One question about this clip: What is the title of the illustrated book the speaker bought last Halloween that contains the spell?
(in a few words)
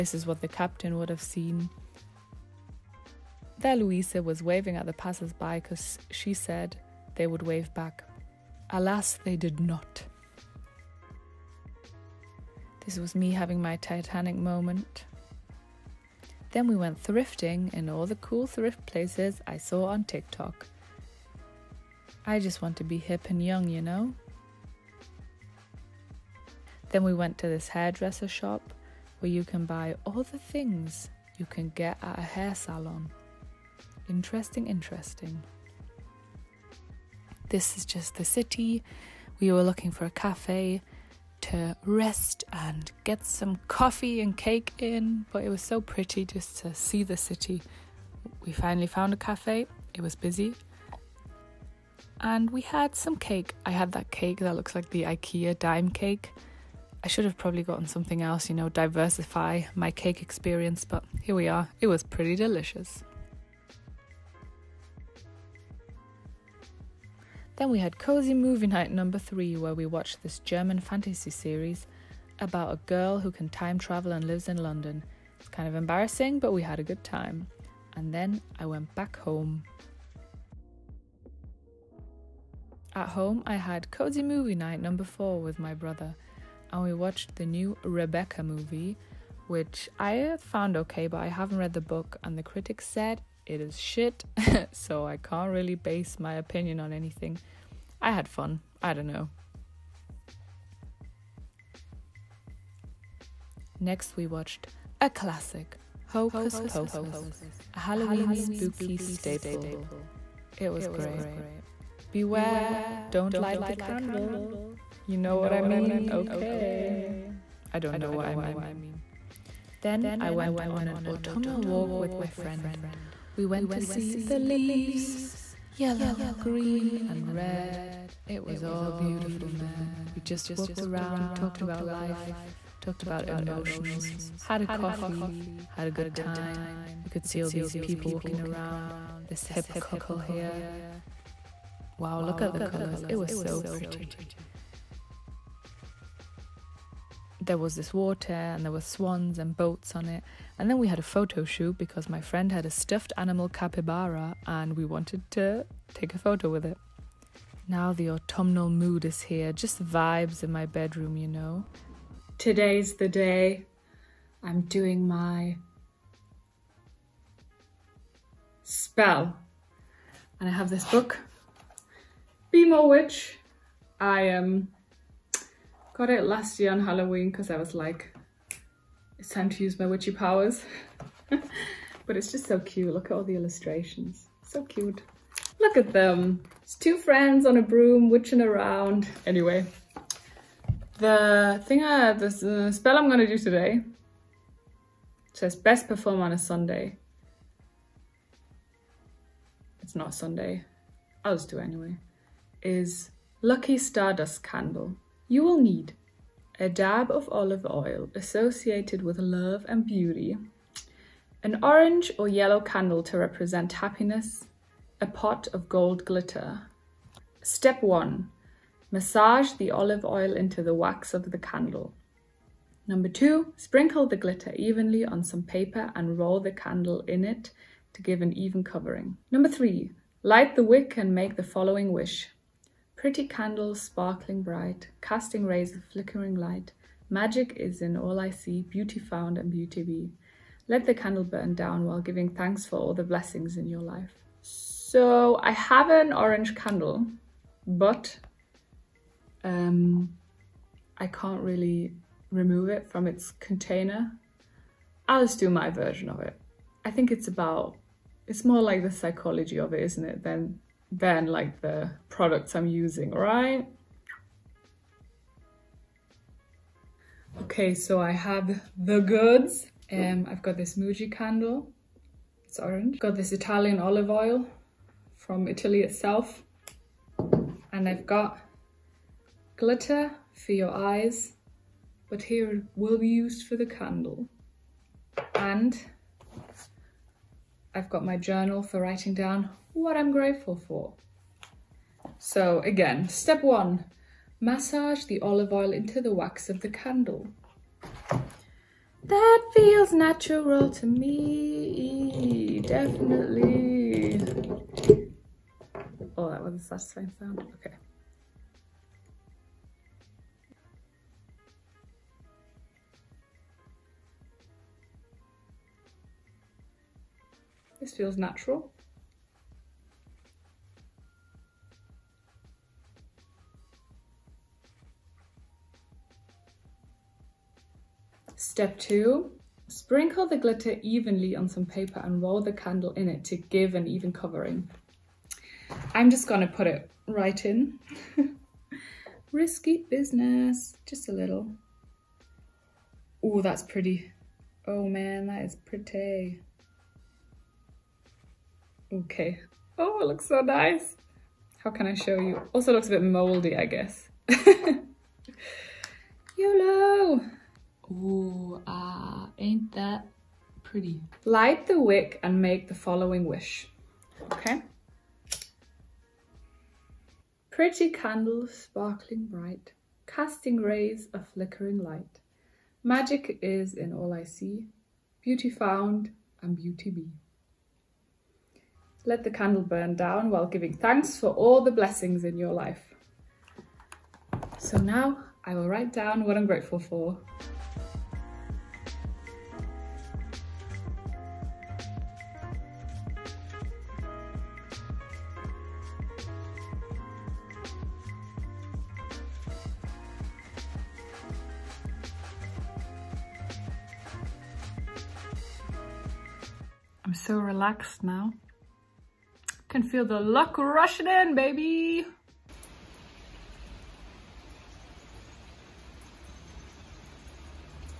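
Be More Witch.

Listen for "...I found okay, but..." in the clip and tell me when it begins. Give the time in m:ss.
1:29.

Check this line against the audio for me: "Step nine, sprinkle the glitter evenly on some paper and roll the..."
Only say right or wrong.
wrong.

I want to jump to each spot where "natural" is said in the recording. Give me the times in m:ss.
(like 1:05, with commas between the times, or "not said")
4:59, 5:18.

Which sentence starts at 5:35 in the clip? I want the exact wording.
I'm just gonna put it right in.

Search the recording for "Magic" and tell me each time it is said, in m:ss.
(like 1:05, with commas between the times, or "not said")
3:57, 6:12.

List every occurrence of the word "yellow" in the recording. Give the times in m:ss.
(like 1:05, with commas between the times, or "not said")
2:05, 3:32.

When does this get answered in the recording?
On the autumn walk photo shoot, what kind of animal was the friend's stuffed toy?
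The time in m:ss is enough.
2:33.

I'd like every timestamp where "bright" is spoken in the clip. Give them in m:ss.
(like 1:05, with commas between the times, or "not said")
3:54, 6:09.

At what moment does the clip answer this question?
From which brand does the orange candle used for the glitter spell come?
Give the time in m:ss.
4:30.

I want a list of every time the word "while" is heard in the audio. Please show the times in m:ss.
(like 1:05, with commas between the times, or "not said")
4:01, 6:20.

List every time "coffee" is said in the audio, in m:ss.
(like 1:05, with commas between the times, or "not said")
0:43, 2:14.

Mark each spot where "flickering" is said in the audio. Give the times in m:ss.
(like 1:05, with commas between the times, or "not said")
3:55, 6:11.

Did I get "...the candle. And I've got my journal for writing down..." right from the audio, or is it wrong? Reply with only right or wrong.
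right.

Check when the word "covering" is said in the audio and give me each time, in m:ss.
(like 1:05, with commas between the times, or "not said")
3:48, 5:34.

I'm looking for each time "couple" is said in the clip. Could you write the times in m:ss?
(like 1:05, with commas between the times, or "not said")
2:19.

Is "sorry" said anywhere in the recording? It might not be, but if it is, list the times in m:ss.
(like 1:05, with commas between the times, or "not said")
not said.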